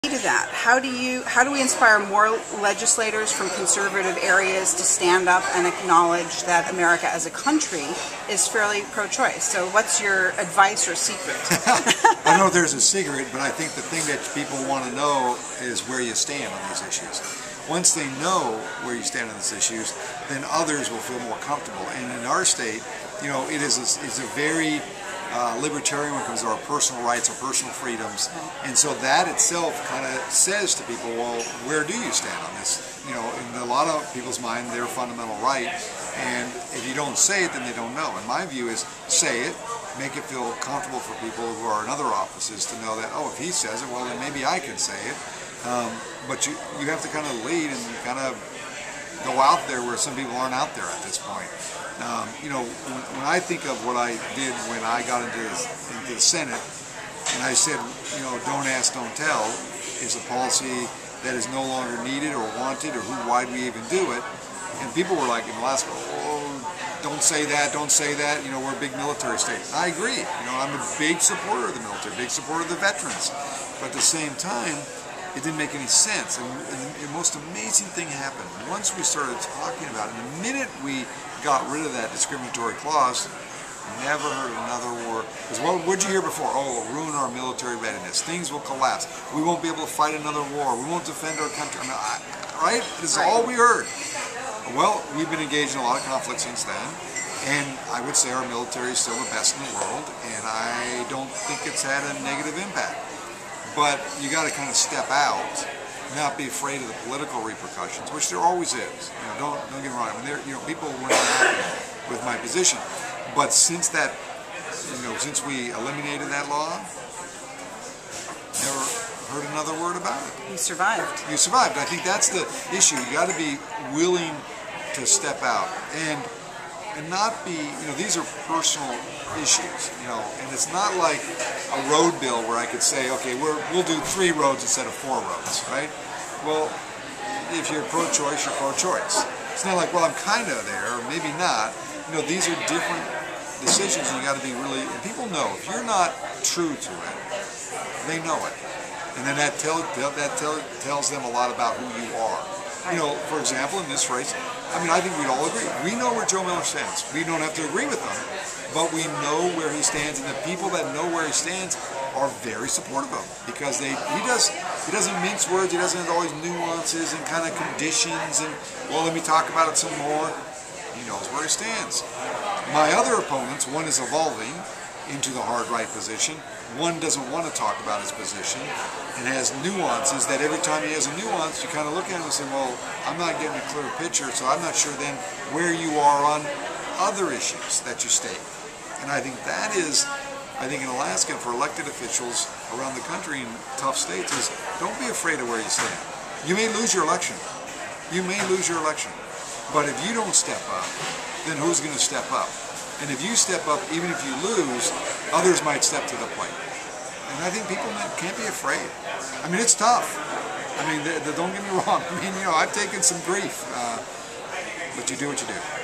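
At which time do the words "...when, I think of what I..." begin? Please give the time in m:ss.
0:53.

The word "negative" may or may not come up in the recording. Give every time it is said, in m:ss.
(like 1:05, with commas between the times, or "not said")
1:42.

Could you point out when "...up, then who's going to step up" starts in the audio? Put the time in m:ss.
3:20.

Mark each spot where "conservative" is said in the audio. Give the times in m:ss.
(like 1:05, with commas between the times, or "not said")
0:03.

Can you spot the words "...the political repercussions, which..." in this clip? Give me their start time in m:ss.
1:46.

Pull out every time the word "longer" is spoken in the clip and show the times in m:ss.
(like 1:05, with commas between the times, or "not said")
1:01.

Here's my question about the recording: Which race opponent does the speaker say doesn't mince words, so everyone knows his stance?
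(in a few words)
Joe Miller.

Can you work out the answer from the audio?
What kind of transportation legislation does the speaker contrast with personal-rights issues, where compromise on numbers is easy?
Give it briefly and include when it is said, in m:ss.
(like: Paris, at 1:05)
Road bill, at 2:11.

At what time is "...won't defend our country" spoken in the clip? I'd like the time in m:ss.
1:30.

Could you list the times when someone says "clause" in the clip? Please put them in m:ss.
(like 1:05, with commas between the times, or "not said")
1:22.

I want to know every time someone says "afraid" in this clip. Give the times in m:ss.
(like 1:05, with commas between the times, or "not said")
1:46, 3:15, 3:28.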